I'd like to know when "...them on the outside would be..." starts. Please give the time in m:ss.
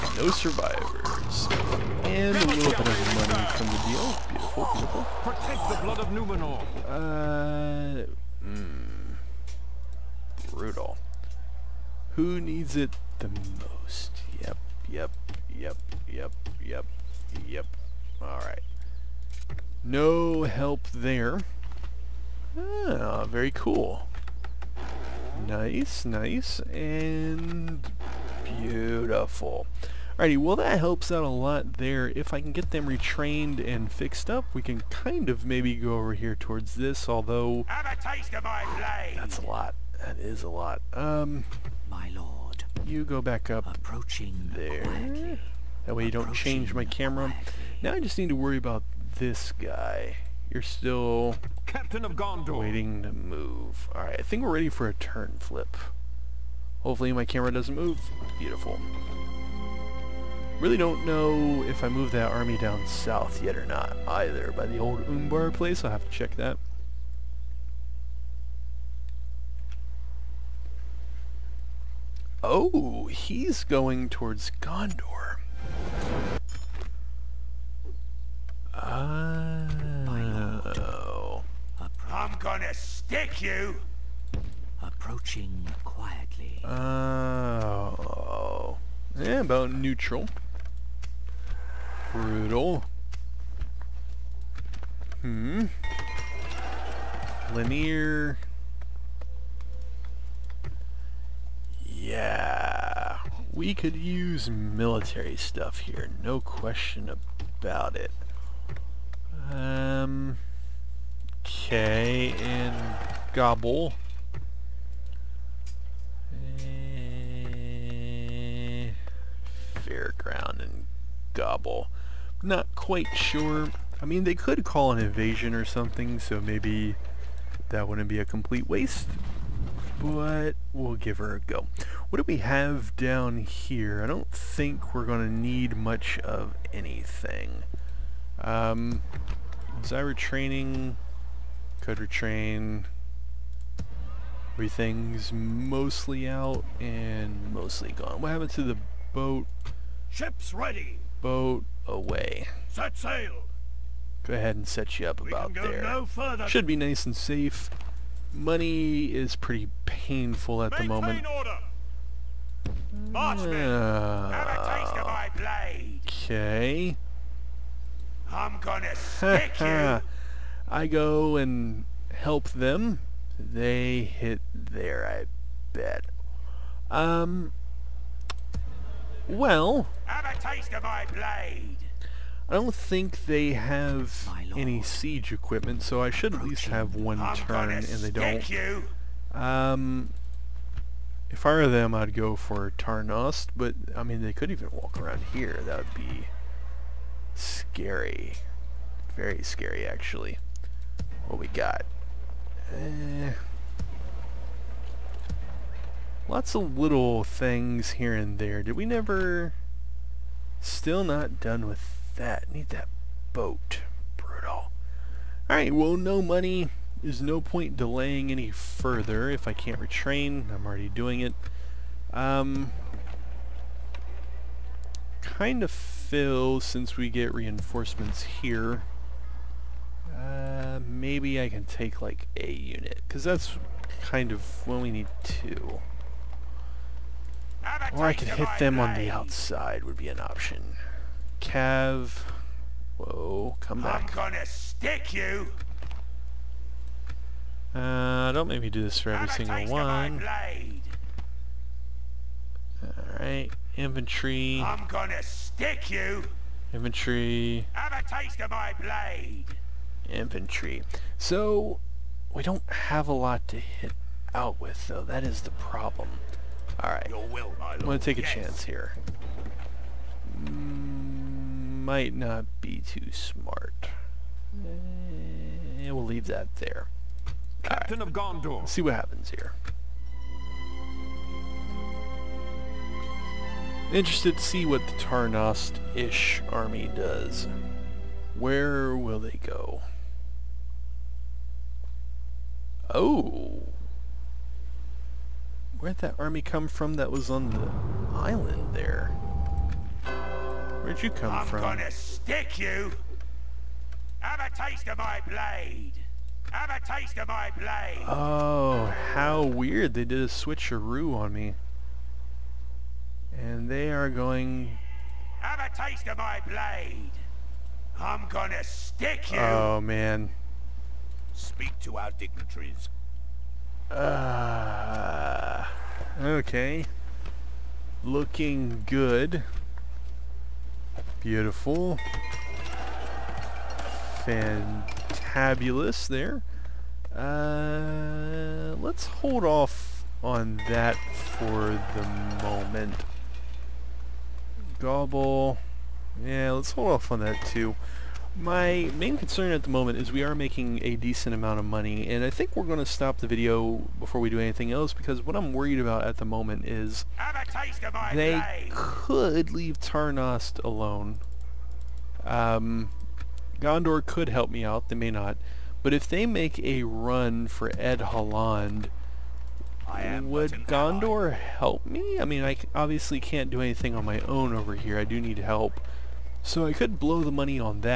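3:58.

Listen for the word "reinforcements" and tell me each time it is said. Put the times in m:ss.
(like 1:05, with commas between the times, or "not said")
3:47.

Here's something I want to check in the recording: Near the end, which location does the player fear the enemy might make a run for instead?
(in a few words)
Edhellond.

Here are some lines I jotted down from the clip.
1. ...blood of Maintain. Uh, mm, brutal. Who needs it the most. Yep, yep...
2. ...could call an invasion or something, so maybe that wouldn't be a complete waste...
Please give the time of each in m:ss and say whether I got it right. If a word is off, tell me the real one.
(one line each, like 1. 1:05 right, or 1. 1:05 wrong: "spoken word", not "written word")
1. 0:05 wrong: "Numenor", not "Maintain"
2. 2:04 right.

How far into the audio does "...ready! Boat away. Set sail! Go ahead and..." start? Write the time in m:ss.
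2:30.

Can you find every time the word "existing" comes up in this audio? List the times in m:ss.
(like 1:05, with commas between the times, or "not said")
not said.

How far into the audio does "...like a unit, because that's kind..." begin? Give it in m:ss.
3:52.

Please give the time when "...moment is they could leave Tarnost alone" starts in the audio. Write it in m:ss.
5:56.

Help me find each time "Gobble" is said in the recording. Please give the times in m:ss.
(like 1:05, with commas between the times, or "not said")
1:53, 2:01, 5:44.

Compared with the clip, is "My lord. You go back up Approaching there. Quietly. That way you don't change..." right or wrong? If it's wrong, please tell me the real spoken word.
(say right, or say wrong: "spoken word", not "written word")
right.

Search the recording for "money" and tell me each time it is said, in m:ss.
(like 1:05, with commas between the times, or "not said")
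0:03, 2:38, 3:36, 5:51, 6:17.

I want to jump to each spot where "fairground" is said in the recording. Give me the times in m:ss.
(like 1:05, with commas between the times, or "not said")
1:59.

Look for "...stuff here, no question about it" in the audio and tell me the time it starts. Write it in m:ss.
1:45.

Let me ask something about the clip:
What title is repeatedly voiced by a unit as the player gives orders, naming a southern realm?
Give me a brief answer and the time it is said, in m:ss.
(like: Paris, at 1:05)
Captain of Gondor, at 0:51.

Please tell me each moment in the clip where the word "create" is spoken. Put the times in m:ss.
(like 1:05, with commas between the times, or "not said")
not said.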